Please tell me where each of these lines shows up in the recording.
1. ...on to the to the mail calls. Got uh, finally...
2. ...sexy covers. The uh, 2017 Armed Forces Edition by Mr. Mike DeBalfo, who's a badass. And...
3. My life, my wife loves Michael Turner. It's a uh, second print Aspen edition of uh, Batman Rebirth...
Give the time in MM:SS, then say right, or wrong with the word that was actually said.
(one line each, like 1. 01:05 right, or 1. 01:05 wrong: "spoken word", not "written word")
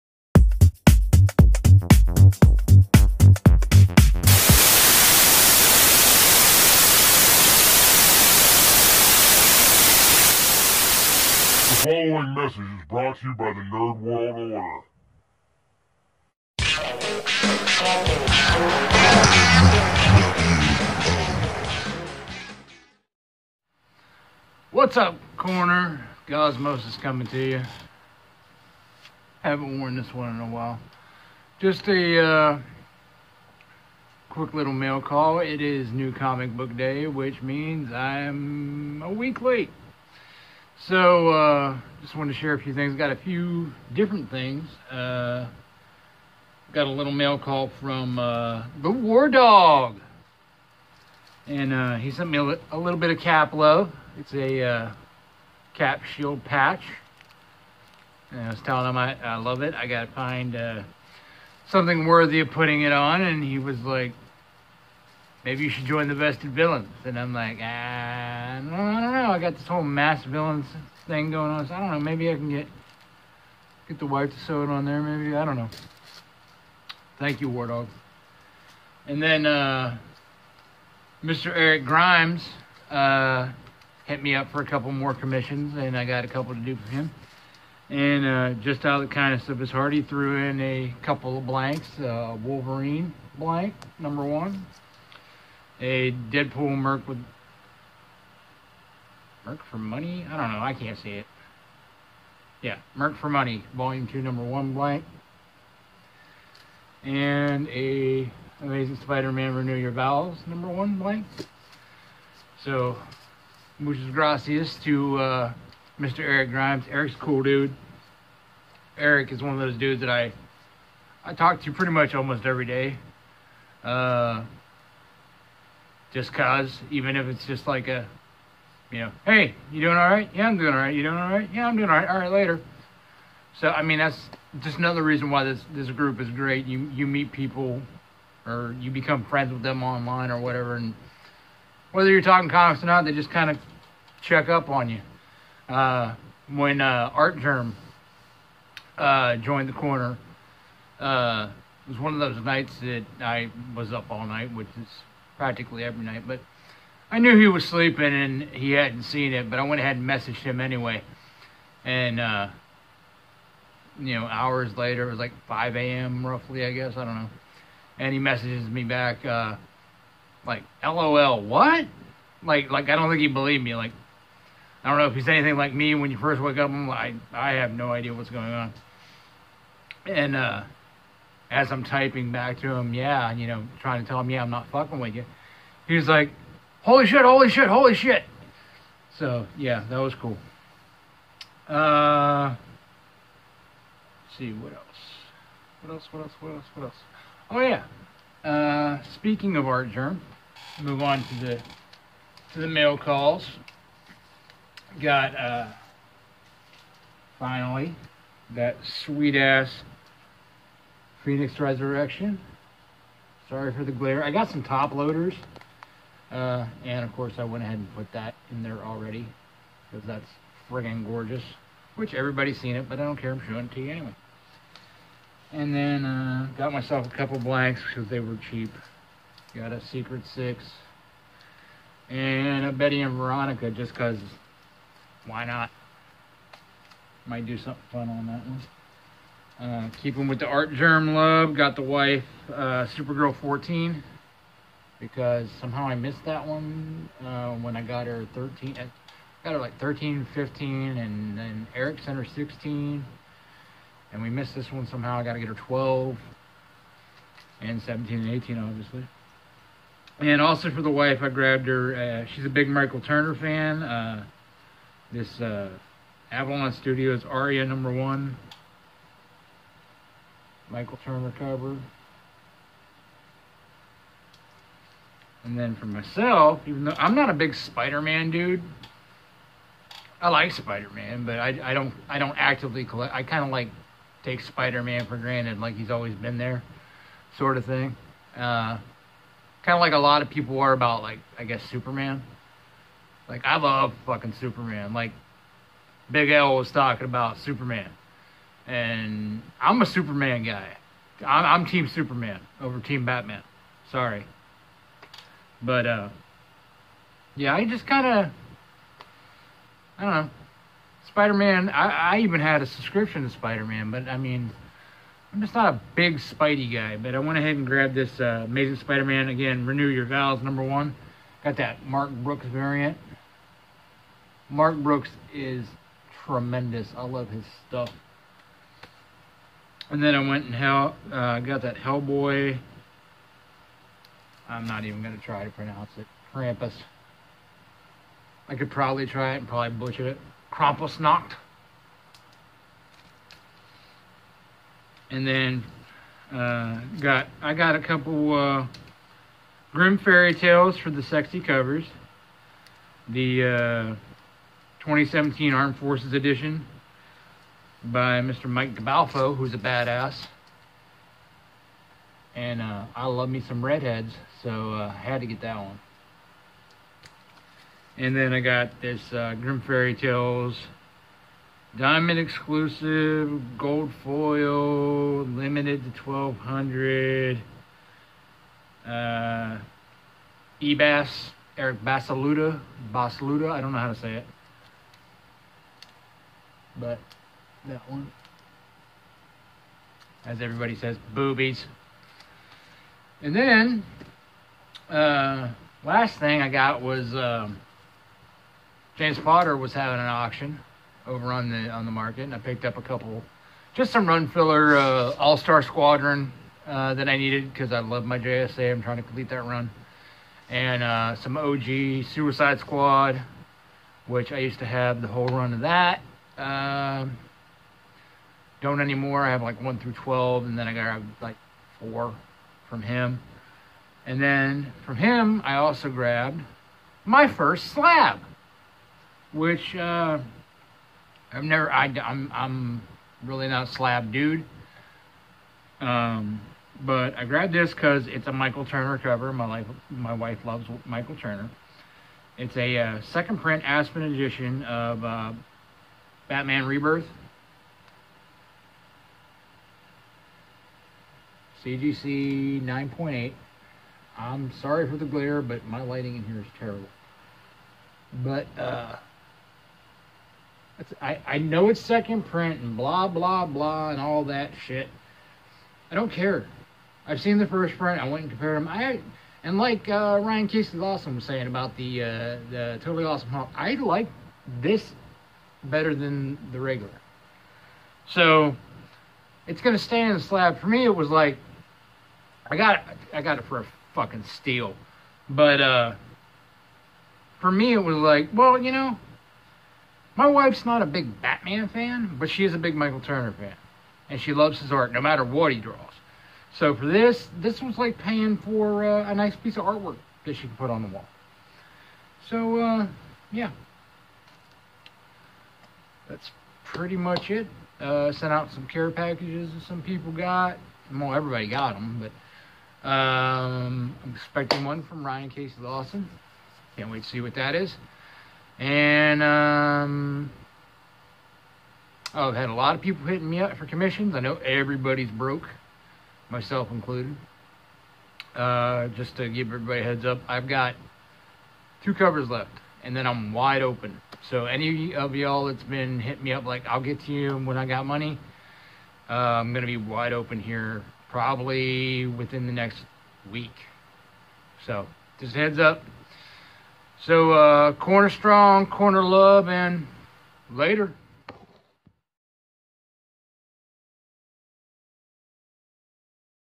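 1. 03:21 right
2. 05:51 right
3. 07:19 right.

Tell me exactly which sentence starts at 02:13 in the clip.
So I mean, that's just another reason why this this group is great.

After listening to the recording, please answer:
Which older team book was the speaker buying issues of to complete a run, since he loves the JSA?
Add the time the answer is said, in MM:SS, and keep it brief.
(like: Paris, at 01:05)
All Star Squadron, at 06:45.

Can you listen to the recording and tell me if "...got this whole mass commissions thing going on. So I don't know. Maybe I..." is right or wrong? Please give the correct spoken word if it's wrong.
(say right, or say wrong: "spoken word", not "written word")
wrong: "villains", not "commissions".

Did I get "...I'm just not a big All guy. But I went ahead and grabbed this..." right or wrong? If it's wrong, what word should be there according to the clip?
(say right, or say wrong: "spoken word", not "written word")
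wrong: "Spidey", not "All".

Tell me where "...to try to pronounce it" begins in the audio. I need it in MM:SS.
05:35.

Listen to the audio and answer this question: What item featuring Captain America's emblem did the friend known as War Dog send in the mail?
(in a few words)
Cap Shield patch.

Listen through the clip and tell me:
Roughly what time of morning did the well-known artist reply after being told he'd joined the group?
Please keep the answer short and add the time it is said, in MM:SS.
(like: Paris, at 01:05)
5 a.m., at 02:45.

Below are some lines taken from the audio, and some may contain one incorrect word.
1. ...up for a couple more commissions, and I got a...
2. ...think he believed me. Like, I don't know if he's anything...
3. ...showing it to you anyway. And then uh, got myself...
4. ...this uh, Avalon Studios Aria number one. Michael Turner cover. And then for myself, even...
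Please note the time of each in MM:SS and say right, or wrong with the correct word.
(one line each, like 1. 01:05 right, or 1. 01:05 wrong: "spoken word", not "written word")
1. 01:24 right
2. 02:53 right
3. 03:43 right
4. 04:25 right.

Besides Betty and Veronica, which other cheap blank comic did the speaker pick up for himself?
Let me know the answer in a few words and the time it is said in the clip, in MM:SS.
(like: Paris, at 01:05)
Secret 6, at 03:49.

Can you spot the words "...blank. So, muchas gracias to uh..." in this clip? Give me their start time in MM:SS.
01:50.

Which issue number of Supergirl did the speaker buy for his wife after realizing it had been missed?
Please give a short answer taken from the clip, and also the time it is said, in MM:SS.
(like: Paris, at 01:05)
14, at 04:02.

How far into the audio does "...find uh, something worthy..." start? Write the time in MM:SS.
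01:00.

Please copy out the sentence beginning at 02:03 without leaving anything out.
Uh, just cause, even if it's just like a, you know, hey, you doing all right?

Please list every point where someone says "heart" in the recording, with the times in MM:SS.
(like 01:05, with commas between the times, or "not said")
01:29.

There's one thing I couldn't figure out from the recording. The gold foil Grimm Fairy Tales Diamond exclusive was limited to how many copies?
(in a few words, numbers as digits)
1200.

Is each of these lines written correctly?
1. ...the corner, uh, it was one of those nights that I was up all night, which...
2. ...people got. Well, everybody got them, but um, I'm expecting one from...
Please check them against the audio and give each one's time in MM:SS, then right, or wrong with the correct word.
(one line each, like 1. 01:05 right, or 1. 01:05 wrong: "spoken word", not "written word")
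1. 02:29 right
2. 08:29 right.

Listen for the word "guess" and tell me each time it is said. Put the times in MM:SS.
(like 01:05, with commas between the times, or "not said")
02:46, 04:51.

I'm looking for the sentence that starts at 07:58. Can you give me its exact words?
So it's going to stay in the slab.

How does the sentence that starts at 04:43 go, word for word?
I kind of like take Spider-Man for granted, like he's always been there, sort of thing.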